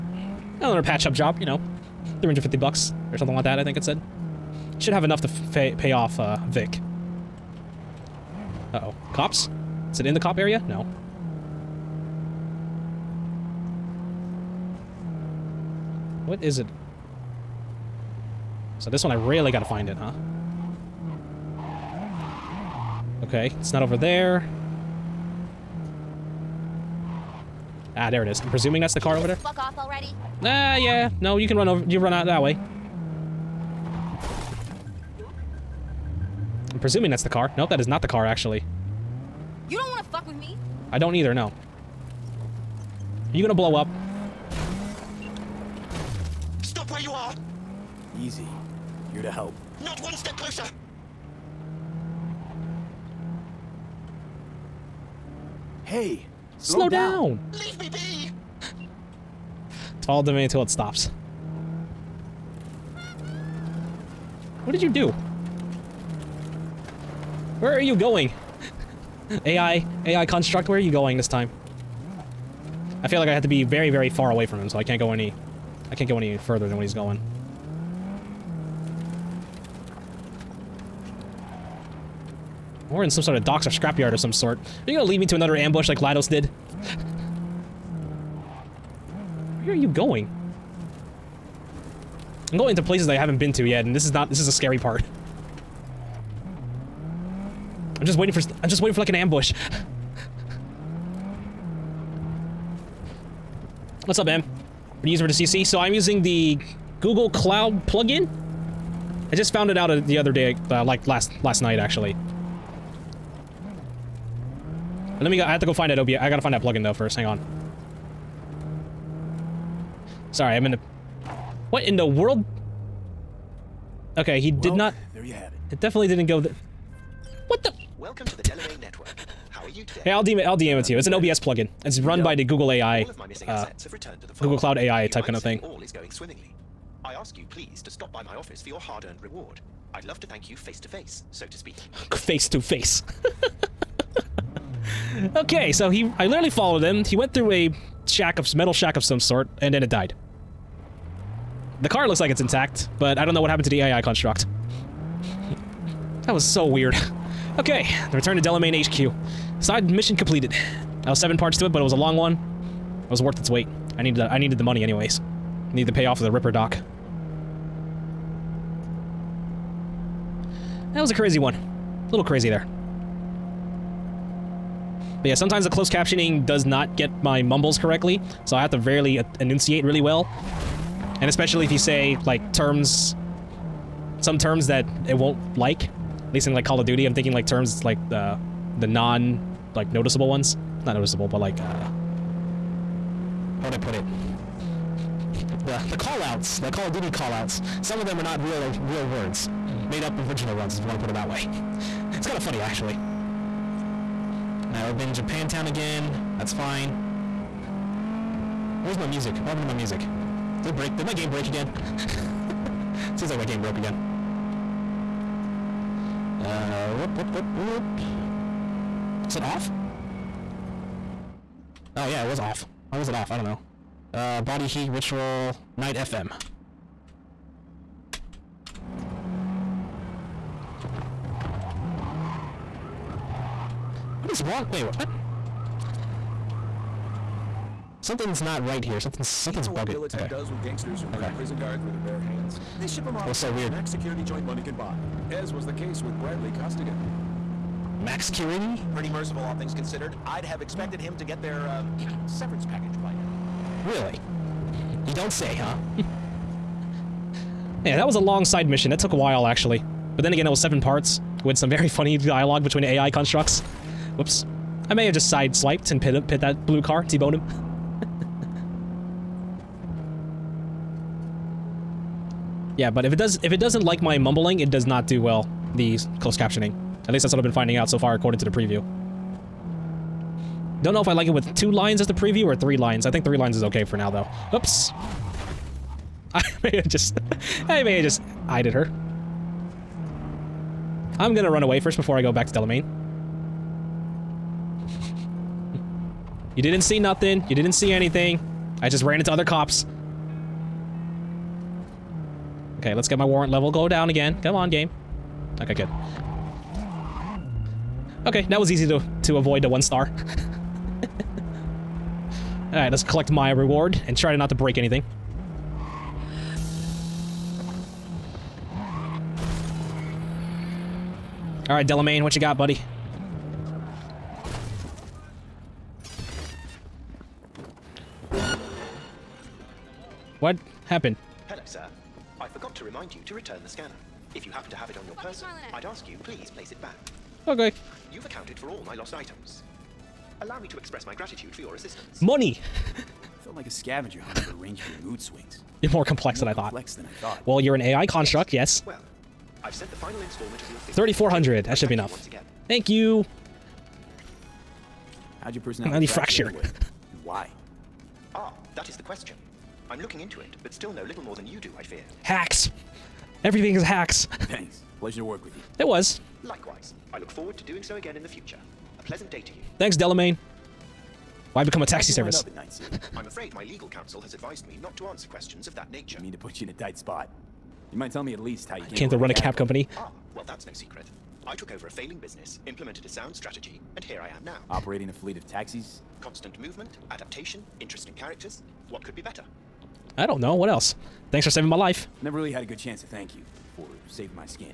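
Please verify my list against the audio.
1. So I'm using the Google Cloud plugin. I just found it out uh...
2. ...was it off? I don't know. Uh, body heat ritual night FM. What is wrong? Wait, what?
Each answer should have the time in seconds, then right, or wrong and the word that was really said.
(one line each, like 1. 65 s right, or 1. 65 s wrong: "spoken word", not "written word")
1. 105 s right
2. 222 s right.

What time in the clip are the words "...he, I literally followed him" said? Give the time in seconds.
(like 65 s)
145 s.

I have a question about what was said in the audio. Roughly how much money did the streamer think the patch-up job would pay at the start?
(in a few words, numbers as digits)
350 bucks.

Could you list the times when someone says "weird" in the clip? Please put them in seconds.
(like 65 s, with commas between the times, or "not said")
156 s, 243 s.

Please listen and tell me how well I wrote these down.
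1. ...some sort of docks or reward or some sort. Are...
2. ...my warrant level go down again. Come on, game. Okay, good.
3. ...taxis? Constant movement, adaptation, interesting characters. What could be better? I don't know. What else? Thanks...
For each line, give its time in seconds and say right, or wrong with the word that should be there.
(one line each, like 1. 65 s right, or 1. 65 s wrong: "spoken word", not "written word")
1. 83 s wrong: "scrapyard", not "reward"
2. 303 s right
3. 385 s right.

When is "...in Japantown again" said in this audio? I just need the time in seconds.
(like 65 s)
205 s.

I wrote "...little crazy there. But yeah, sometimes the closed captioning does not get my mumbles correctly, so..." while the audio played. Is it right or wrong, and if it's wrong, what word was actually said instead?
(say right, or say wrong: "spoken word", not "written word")
right.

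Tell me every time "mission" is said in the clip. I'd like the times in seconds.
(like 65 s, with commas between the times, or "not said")
159 s, 258 s.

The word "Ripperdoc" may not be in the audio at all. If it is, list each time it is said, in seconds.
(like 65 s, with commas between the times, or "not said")
166 s.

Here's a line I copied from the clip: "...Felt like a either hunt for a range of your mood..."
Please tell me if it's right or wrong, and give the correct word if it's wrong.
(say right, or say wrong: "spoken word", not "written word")
wrong: "scavenger", not "either".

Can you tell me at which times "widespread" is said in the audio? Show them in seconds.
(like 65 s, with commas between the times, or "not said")
not said.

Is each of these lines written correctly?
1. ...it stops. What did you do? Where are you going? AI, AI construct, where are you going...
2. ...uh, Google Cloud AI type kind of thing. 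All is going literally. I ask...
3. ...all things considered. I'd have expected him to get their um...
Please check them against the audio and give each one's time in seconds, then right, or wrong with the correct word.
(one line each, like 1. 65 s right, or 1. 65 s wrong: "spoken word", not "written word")
1. 60 s right
2. 133 s wrong: "swimmingly", not "literally"
3. 249 s right.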